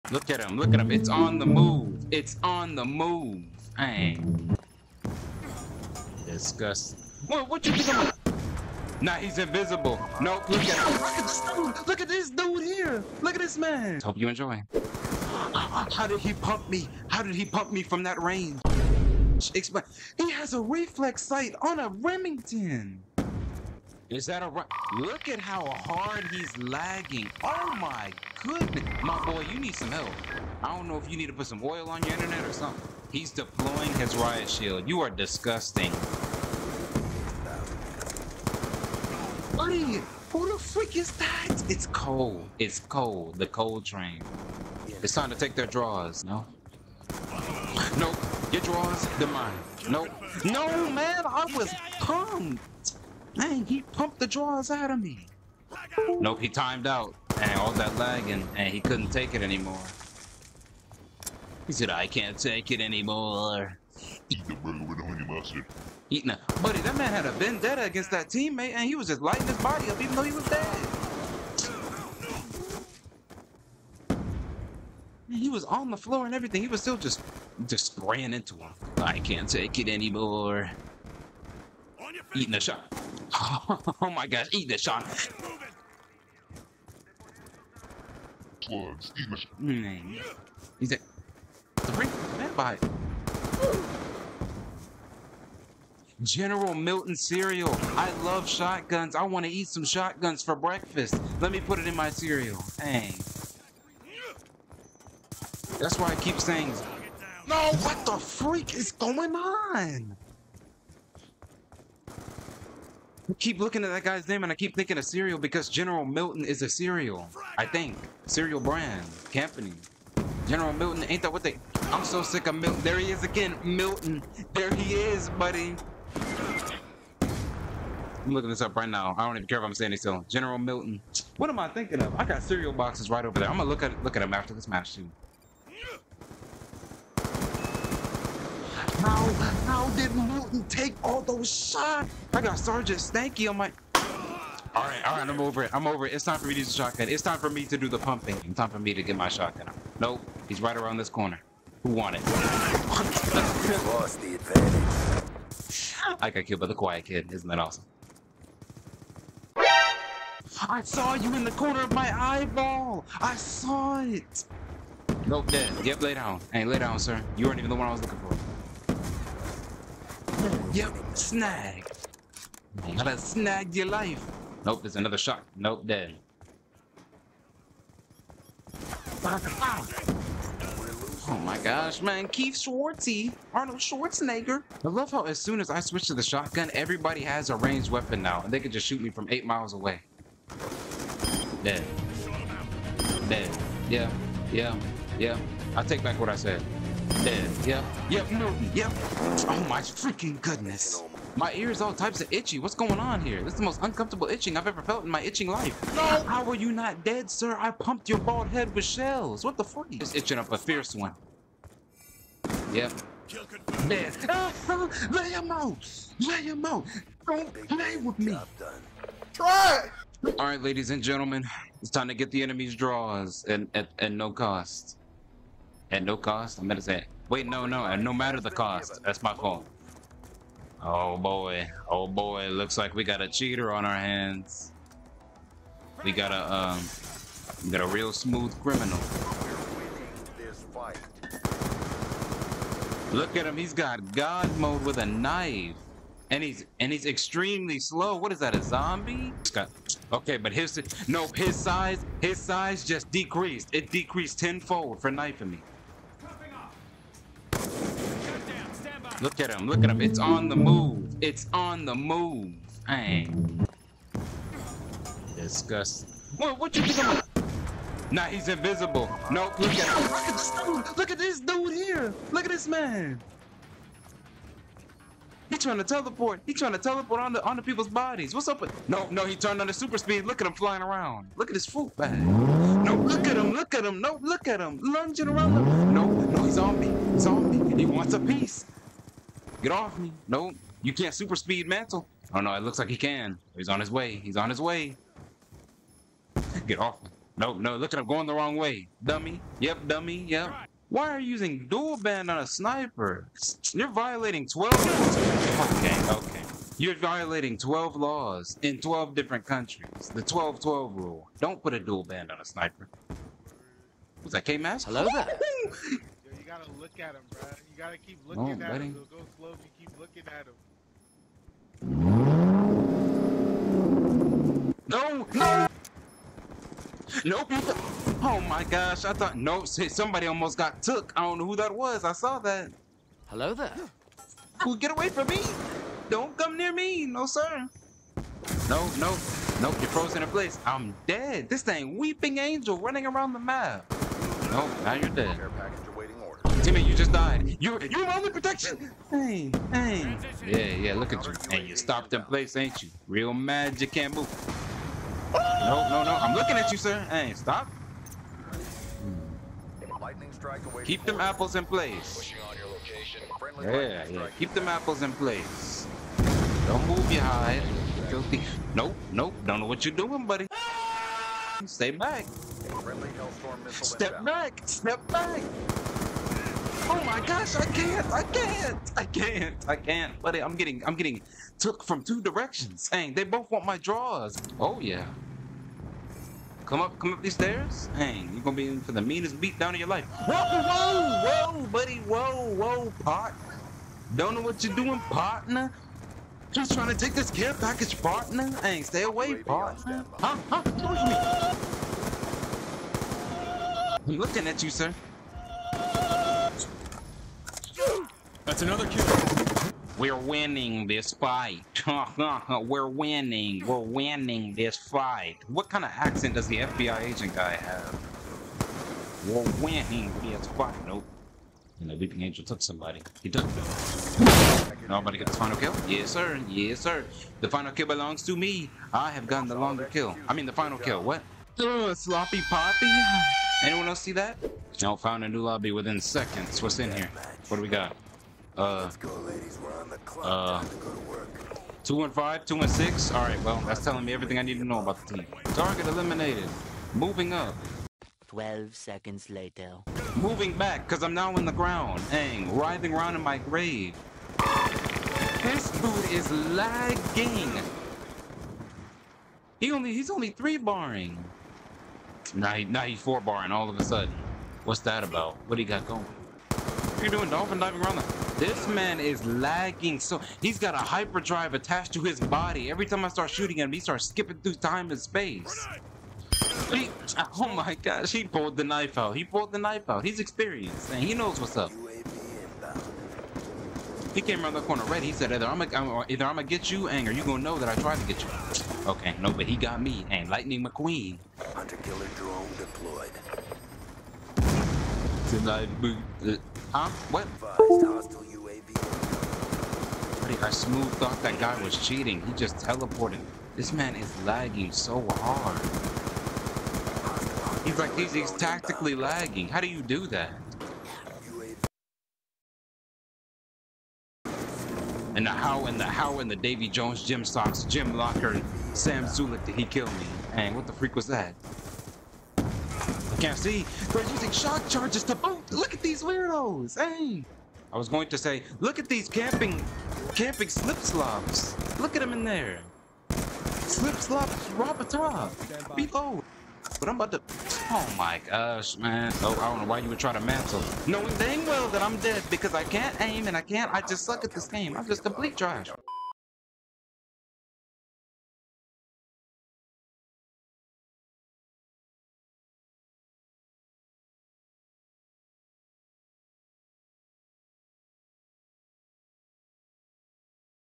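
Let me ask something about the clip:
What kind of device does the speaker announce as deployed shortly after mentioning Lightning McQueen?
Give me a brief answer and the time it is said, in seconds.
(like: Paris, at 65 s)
Hunter killer drone, at 491 s.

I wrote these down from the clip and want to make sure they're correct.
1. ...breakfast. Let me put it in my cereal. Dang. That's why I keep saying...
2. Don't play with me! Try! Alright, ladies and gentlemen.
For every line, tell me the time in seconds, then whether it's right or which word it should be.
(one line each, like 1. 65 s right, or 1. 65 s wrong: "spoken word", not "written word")
1. 100 s right
2. 217 s right.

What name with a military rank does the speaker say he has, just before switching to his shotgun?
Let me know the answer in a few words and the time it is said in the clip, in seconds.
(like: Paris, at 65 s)
Sergeant Stanky, at 142 s.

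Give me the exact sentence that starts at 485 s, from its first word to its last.
He said, either I'm gonna, either I'm gonna get you, or you gonna know that I tried to get you.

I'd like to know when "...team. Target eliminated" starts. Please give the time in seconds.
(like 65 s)
445 s.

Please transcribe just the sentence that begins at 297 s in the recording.
No, no, look at him going the wrong way.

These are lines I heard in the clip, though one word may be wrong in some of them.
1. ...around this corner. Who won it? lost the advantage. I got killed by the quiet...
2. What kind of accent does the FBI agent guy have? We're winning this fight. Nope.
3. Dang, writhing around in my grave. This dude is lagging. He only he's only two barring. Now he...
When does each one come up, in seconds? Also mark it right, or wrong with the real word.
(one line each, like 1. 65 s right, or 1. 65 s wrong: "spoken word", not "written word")
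1. 150 s right
2. 415 s right
3. 452 s wrong: "three", not "two".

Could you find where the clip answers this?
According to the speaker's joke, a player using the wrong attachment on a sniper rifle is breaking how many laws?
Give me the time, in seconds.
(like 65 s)
307 s.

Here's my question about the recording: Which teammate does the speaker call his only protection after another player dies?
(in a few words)
Timmy.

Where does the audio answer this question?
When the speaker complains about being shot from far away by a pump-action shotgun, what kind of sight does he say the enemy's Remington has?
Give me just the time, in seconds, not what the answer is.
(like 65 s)
20 s.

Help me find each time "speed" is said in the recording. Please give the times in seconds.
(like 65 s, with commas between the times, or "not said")
279 s, 291 s.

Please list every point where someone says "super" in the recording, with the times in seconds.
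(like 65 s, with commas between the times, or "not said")
279 s, 291 s.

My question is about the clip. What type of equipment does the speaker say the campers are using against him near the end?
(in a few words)
shock charges.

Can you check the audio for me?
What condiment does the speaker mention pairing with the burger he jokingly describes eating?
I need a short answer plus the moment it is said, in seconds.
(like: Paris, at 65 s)
honey mustard, at 65 s.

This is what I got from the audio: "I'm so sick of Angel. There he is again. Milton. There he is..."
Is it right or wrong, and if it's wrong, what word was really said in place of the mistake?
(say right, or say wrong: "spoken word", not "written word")
wrong: "Milton", not "Angel".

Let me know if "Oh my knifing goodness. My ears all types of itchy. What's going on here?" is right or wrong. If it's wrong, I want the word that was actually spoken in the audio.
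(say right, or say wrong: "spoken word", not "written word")
wrong: "freaking", not "knifing".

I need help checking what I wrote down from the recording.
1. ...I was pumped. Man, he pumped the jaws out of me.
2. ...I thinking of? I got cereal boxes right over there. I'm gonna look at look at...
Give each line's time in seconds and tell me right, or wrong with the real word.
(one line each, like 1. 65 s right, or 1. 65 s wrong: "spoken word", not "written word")
1. 51 s right
2. 131 s right.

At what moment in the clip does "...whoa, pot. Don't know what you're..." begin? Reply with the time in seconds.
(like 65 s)
392 s.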